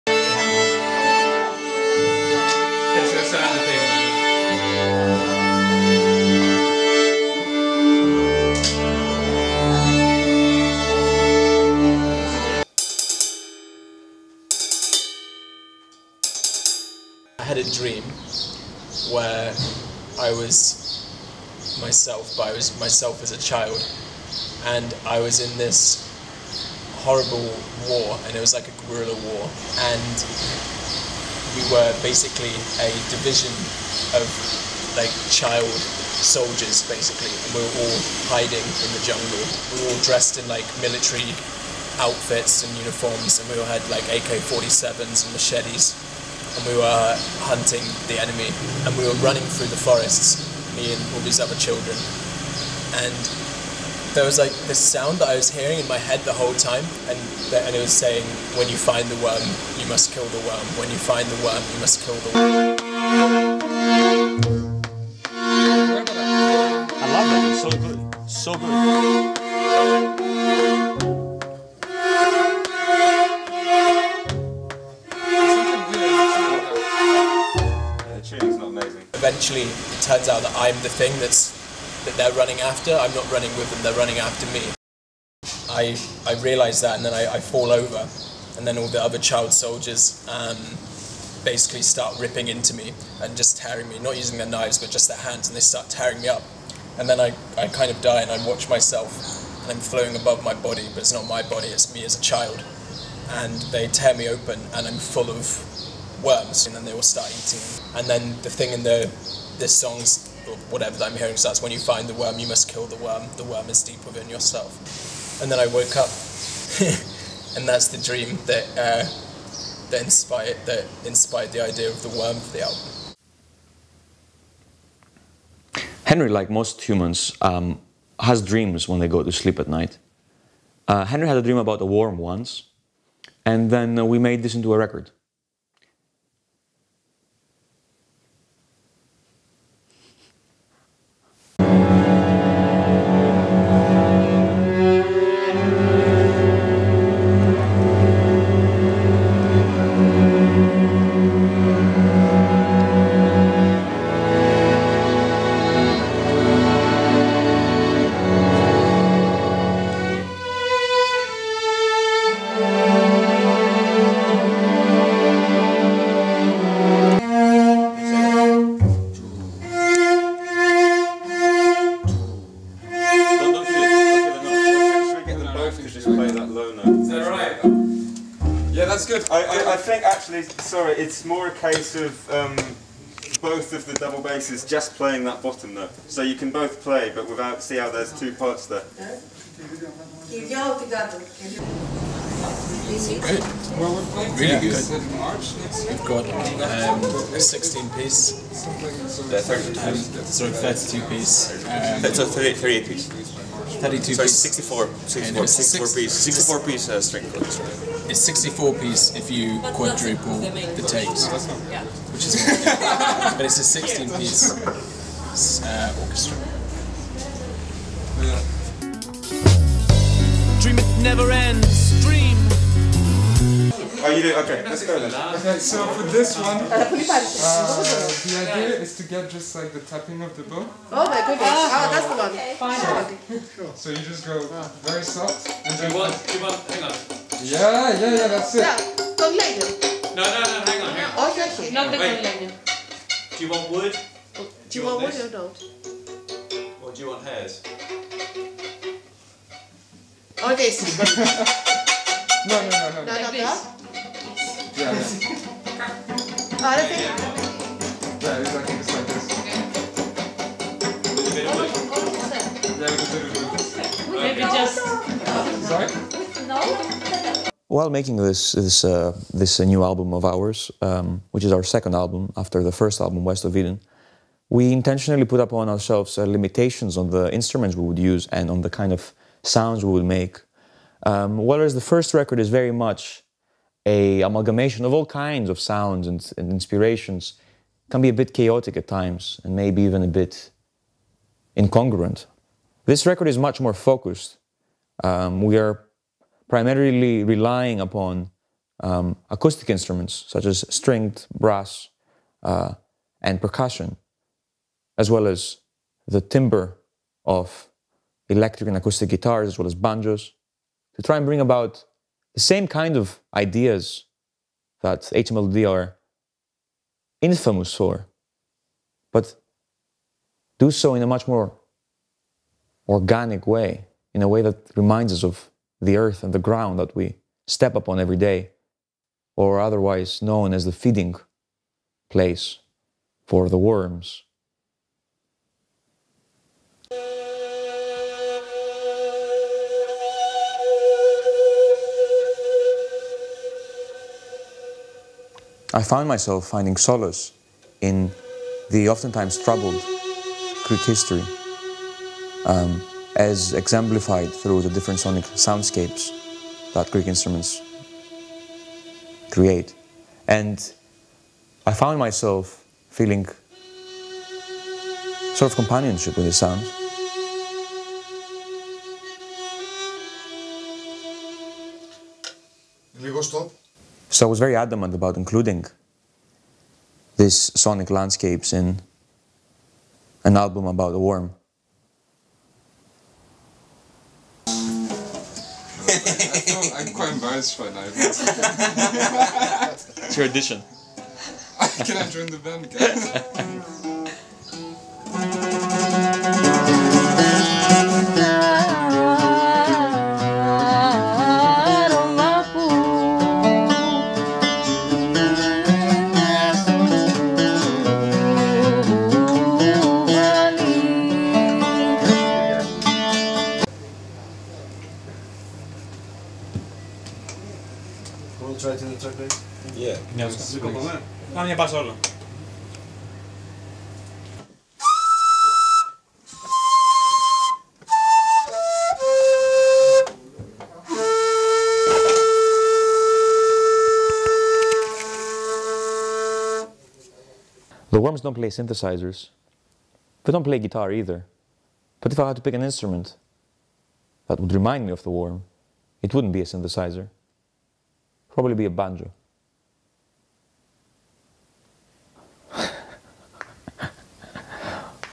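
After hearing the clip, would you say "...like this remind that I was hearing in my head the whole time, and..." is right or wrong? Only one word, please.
wrong.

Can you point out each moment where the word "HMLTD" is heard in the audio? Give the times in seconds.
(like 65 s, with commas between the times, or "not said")
315 s.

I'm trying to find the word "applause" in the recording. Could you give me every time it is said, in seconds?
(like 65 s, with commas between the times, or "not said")
not said.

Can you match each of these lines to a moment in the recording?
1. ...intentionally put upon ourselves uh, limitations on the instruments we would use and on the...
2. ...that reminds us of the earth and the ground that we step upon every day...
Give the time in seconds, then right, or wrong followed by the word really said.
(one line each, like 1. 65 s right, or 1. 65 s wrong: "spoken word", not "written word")
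1. 274 s right
2. 324 s right.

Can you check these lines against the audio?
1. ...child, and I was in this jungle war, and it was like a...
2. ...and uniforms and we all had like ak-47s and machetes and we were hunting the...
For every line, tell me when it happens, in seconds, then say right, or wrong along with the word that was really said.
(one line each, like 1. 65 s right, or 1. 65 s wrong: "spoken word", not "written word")
1. 23 s wrong: "horrible", not "jungle"
2. 42 s right.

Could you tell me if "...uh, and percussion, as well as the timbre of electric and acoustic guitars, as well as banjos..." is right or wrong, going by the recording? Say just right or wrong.
right.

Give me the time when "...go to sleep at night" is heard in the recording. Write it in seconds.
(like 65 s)
129 s.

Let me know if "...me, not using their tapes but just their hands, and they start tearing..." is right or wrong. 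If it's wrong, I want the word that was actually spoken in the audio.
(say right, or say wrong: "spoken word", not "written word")
wrong: "knives", not "tapes".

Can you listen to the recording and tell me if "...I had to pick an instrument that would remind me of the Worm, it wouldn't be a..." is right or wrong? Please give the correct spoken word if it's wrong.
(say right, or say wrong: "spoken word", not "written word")
right.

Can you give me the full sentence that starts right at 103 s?
And they tear me open, and I'm full of worms, and then they will start eating.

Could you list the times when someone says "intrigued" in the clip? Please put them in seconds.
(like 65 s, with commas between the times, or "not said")
not said.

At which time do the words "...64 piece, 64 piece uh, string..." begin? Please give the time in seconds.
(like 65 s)
205 s.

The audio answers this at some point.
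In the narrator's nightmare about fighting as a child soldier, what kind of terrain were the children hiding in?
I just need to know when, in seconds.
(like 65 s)
39 s.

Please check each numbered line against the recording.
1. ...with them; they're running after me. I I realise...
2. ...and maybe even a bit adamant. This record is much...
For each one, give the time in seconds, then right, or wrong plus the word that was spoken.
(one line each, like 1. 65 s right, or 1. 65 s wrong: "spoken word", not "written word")
1. 83 s right
2. 289 s wrong: "incongruent", not "adamant".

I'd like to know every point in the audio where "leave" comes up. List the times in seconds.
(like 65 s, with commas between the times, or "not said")
not said.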